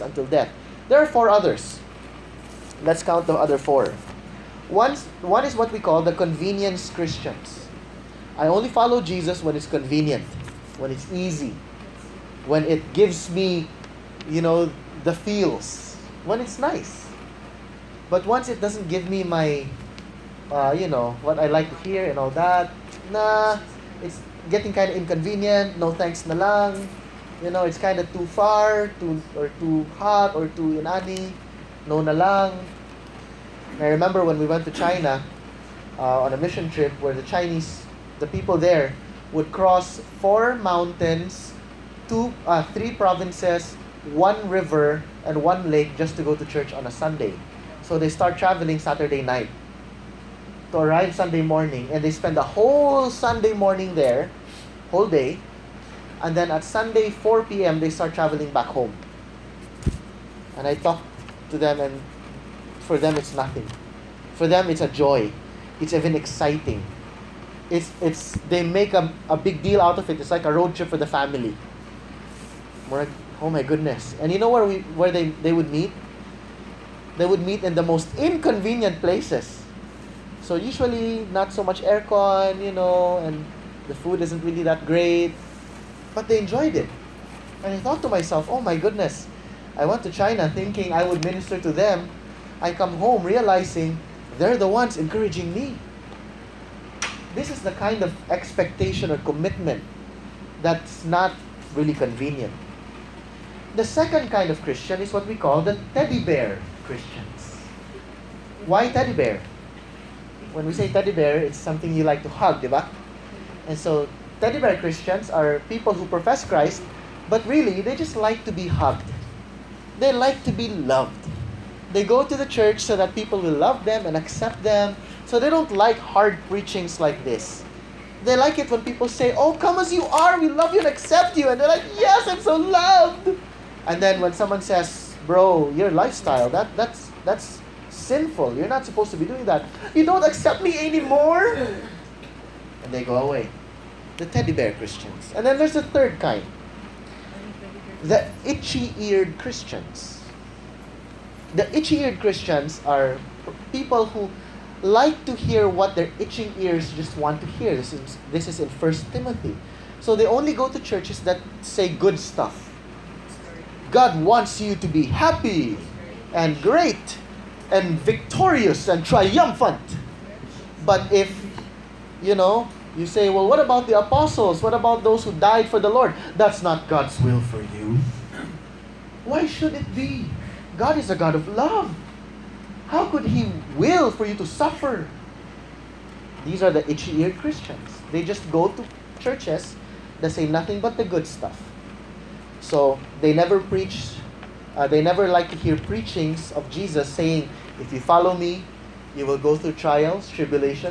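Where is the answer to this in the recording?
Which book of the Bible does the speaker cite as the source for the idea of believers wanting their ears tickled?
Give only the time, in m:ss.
2:38.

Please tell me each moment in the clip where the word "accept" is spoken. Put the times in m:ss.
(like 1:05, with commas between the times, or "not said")
2:04, 2:10, 2:20.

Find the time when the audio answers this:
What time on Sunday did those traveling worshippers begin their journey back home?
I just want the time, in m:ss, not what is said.
0:57.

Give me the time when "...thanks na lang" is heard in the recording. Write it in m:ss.
0:25.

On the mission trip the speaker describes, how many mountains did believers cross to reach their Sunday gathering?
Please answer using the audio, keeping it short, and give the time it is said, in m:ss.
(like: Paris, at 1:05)
4, at 0:40.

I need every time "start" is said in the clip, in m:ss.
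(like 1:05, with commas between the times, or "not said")
0:48, 0:57.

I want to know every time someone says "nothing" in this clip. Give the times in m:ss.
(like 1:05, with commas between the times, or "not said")
1:03, 3:10.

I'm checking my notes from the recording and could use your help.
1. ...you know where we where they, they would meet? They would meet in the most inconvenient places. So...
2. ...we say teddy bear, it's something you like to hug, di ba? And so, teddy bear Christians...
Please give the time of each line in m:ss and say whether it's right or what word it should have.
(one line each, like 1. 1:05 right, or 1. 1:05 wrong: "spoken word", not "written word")
1. 1:14 right
2. 1:50 right.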